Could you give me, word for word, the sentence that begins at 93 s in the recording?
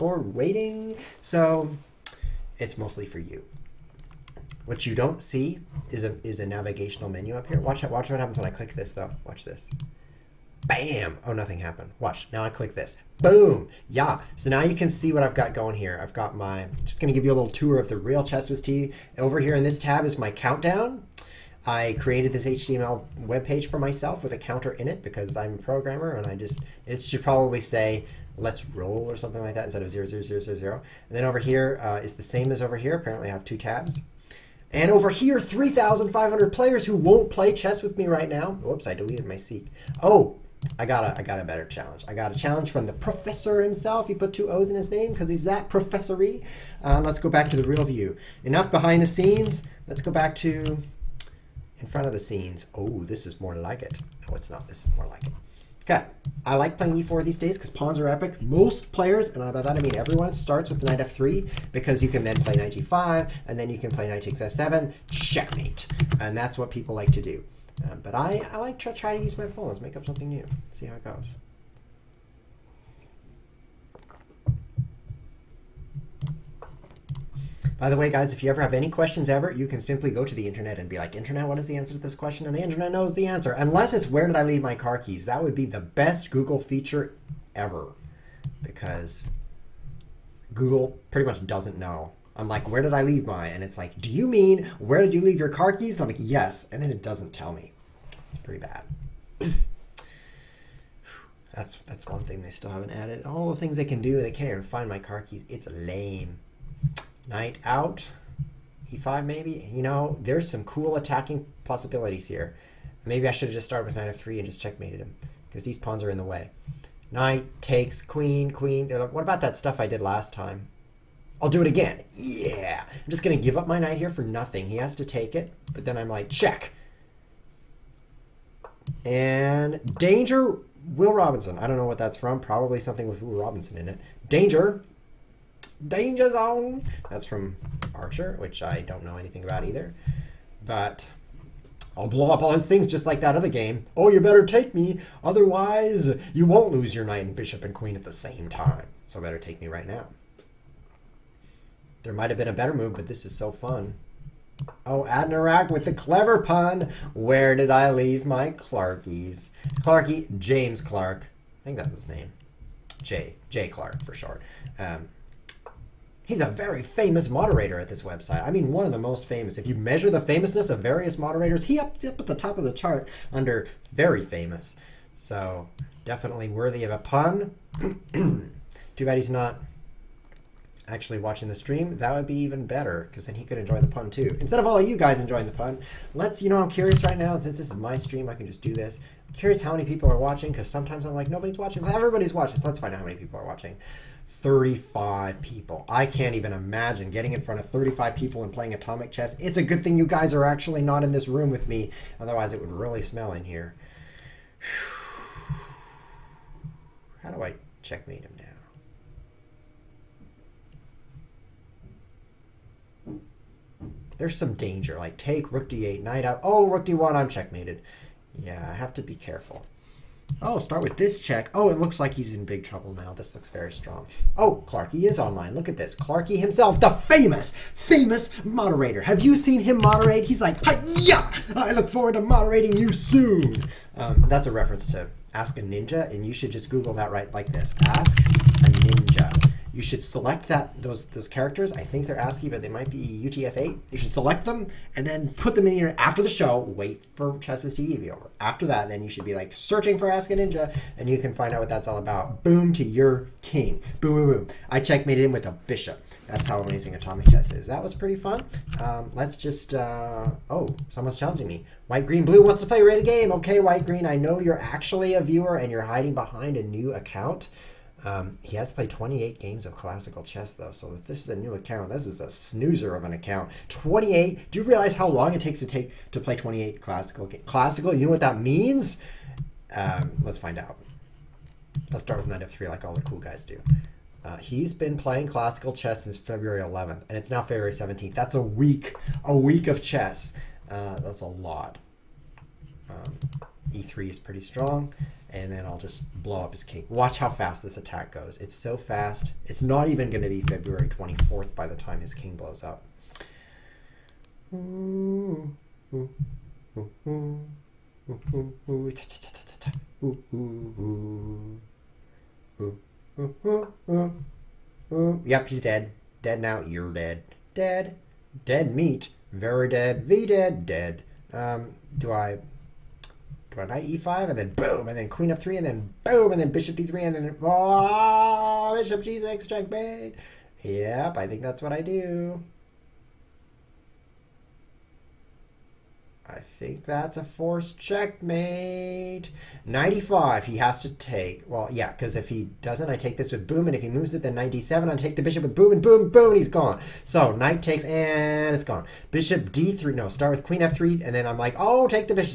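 And it's like, do you mean where did you leave your car keys?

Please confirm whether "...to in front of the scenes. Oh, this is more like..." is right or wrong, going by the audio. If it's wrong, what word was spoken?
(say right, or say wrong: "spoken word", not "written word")
right.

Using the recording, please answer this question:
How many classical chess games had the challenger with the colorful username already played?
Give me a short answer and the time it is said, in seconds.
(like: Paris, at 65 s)
28, at 268 s.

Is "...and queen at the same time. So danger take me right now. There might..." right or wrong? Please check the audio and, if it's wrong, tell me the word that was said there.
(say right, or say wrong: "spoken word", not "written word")
wrong: "better", not "danger".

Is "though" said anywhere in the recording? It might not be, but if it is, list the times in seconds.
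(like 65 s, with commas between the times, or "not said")
8 s, 270 s.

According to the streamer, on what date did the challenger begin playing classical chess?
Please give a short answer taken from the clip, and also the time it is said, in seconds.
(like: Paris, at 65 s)
February 11th, at 286 s.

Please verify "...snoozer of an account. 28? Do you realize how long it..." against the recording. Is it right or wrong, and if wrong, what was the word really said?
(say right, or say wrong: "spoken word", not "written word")
right.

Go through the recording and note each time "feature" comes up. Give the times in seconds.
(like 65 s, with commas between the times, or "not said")
86 s.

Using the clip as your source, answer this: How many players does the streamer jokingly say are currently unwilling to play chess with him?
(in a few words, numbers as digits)
3,500.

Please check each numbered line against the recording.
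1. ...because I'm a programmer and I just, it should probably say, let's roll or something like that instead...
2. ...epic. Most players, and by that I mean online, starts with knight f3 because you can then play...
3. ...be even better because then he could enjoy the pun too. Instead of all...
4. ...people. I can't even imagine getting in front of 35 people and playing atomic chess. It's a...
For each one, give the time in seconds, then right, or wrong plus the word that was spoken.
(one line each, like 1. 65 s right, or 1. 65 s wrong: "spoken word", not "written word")
1. 25 s right
2. 58 s wrong: "everyone", not "online"
3. 182 s right
4. 195 s right.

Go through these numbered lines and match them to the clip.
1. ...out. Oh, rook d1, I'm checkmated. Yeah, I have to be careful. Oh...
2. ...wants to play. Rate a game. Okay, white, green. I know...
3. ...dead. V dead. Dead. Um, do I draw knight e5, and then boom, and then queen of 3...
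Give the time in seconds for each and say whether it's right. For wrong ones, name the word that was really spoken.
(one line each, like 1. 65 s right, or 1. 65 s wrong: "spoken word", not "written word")
1. 216 s right
2. 262 s right
3. 319 s right.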